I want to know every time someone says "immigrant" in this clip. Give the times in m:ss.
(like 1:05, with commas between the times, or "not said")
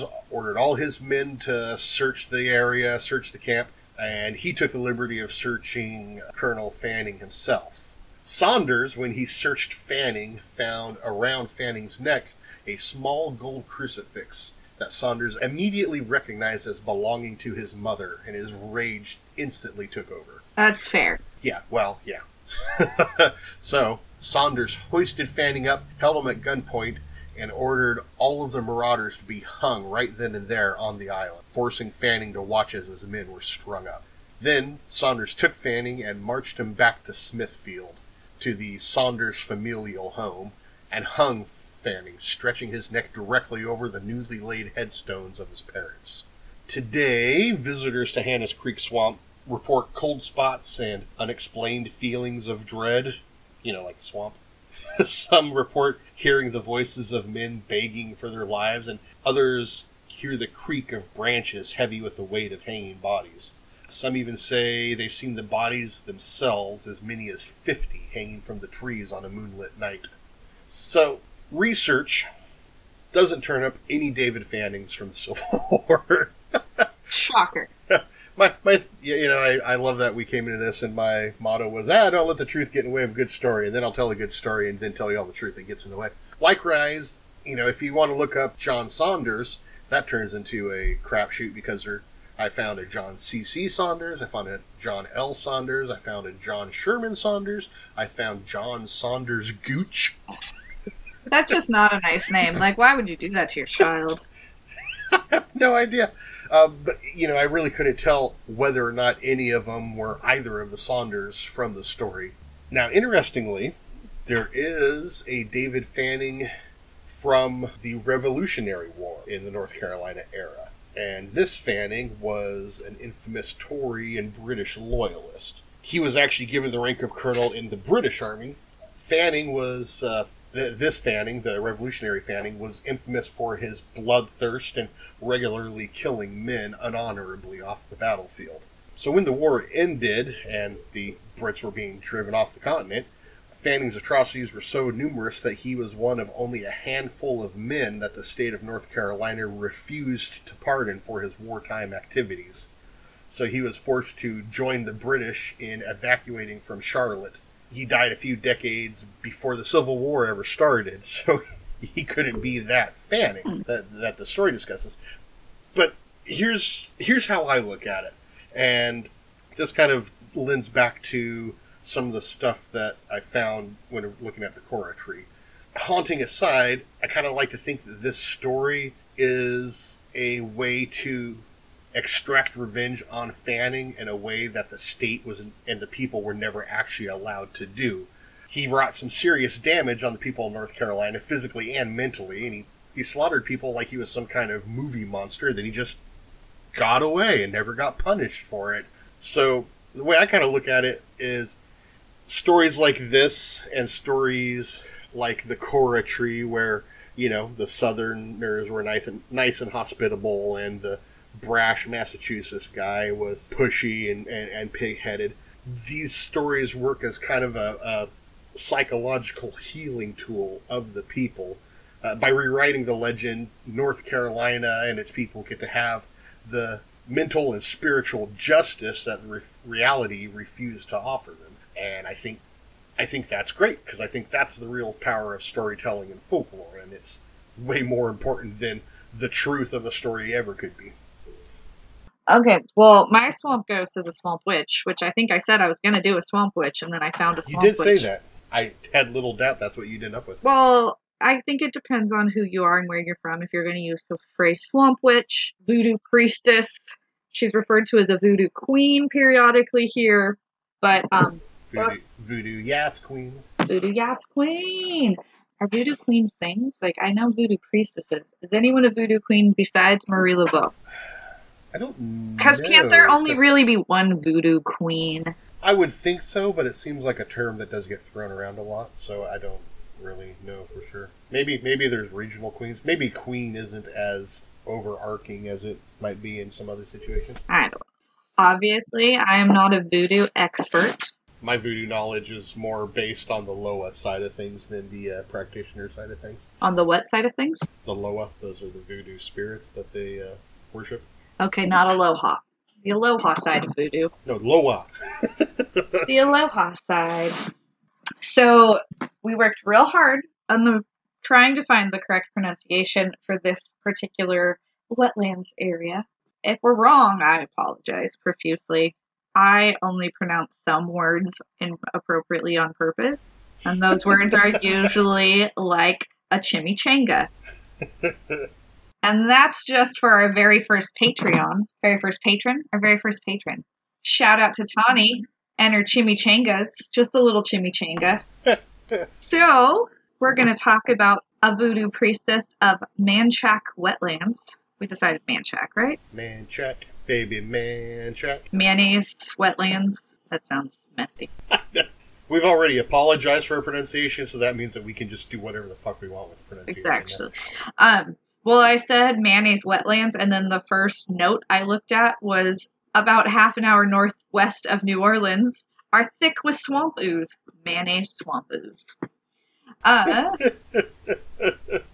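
not said.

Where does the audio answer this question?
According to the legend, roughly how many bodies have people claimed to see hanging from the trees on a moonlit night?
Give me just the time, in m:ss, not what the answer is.
1:07.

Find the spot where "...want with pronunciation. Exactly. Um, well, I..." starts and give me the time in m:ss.
5:56.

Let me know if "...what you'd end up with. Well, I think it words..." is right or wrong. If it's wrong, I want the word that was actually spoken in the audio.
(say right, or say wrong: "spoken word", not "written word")
wrong: "depends", not "words".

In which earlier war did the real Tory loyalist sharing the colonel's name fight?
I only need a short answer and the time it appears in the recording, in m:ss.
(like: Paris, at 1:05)
Revolutionary War, at 1:57.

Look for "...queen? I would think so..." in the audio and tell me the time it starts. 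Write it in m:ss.
4:34.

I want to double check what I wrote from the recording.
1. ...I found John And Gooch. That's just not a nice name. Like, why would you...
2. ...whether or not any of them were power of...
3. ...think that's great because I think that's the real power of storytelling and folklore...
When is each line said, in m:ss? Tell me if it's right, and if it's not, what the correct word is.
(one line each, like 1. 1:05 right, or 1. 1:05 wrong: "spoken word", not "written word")
1. 1:37 wrong: "Saunders", not "And"
2. 1:48 wrong: "either", not "power"
3. 3:53 right.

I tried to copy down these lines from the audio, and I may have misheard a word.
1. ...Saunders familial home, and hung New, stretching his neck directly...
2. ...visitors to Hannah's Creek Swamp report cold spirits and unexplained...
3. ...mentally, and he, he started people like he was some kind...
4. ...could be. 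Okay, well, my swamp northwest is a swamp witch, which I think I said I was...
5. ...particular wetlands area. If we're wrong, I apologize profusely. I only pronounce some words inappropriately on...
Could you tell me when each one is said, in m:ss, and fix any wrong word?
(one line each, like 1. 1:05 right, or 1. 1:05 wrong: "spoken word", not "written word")
1. 0:38 wrong: "Fanning", not "New"
2. 0:47 wrong: "spots", not "spirits"
3. 3:11 wrong: "slaughtered", not "started"
4. 4:00 wrong: "ghost", not "northwest"
5. 5:13 right.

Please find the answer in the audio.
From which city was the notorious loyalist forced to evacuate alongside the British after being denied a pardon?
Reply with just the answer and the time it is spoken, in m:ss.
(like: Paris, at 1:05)
Charlotte, at 2:36.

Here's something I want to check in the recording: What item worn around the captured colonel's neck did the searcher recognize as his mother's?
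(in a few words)
gold crucifix.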